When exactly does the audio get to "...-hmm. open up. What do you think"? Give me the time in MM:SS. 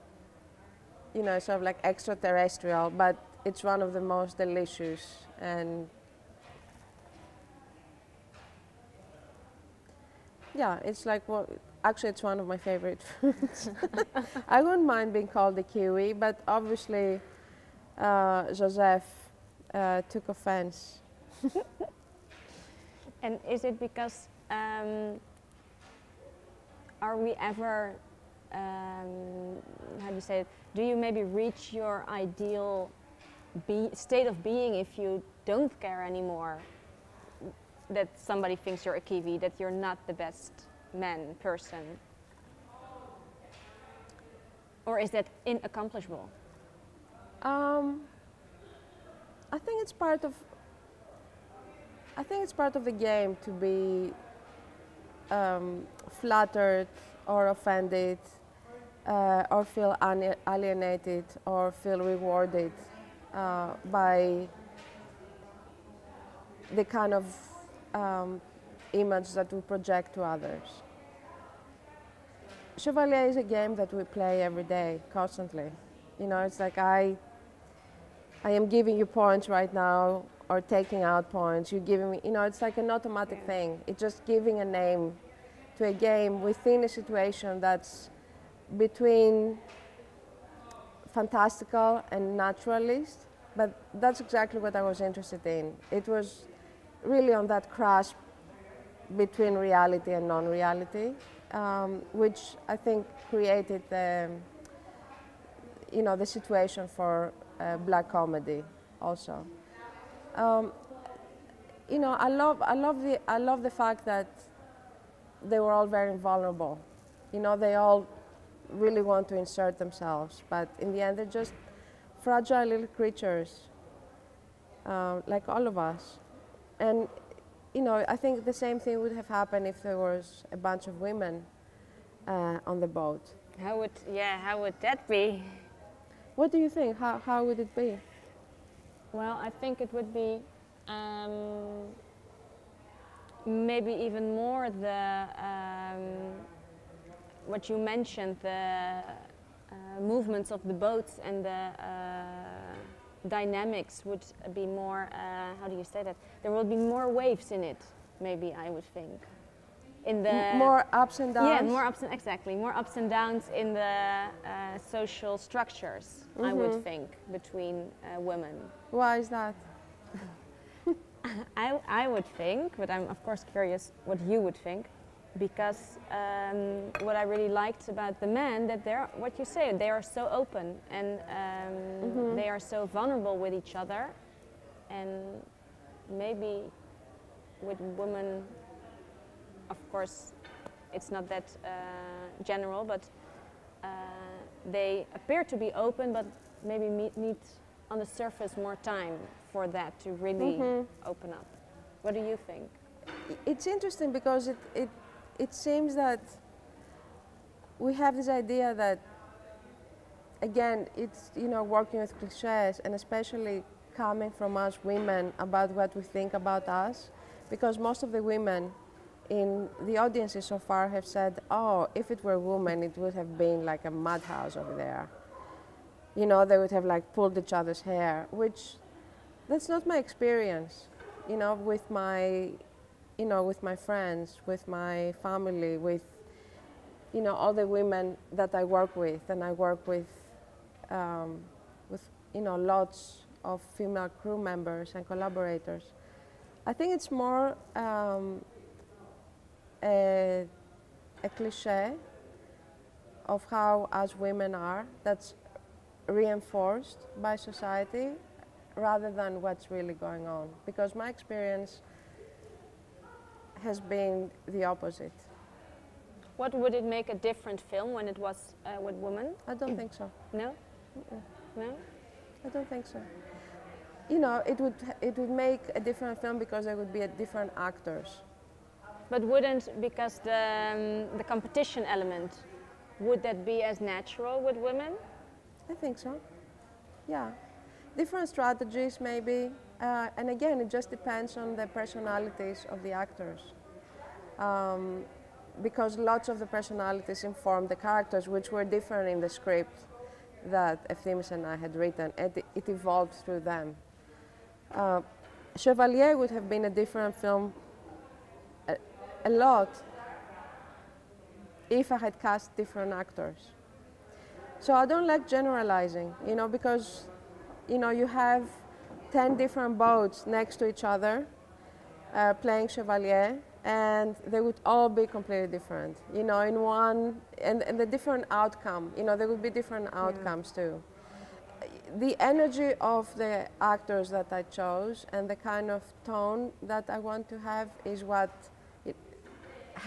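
03:20.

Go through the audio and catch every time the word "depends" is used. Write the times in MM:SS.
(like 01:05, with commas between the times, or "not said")
04:50.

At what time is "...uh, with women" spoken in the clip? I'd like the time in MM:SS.
04:28.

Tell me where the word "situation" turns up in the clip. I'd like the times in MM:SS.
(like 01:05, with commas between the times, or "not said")
01:26, 01:46.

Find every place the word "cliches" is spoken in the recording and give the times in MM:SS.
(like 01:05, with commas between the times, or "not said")
03:32, 04:11.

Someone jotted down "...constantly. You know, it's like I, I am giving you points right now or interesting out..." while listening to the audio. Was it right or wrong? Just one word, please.
wrong.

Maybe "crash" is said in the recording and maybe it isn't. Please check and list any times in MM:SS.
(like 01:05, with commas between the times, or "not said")
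01:37.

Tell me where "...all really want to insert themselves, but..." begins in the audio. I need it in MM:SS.
01:57.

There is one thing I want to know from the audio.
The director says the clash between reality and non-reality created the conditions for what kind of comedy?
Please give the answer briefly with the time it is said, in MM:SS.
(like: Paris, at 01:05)
black comedy, at 01:47.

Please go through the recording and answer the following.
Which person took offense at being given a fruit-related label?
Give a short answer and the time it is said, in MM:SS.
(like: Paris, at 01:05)
Joseph, at 00:18.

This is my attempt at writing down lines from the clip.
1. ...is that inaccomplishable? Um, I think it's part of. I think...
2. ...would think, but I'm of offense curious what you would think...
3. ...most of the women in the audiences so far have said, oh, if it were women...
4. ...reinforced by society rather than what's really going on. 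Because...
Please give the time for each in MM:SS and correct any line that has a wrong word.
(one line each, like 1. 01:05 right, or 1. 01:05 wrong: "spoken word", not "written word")
1. 00:44 right
2. 02:52 wrong: "course", not "offense"
3. 03:37 right
4. 04:16 right.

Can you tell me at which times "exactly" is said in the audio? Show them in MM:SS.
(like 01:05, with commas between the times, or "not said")
01:34, 02:42.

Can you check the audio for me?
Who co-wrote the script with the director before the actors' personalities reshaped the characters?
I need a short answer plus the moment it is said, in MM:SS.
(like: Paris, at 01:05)
Efthymis, at 05:00.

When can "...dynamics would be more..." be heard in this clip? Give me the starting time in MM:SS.
02:33.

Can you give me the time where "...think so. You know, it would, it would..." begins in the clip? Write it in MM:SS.
04:32.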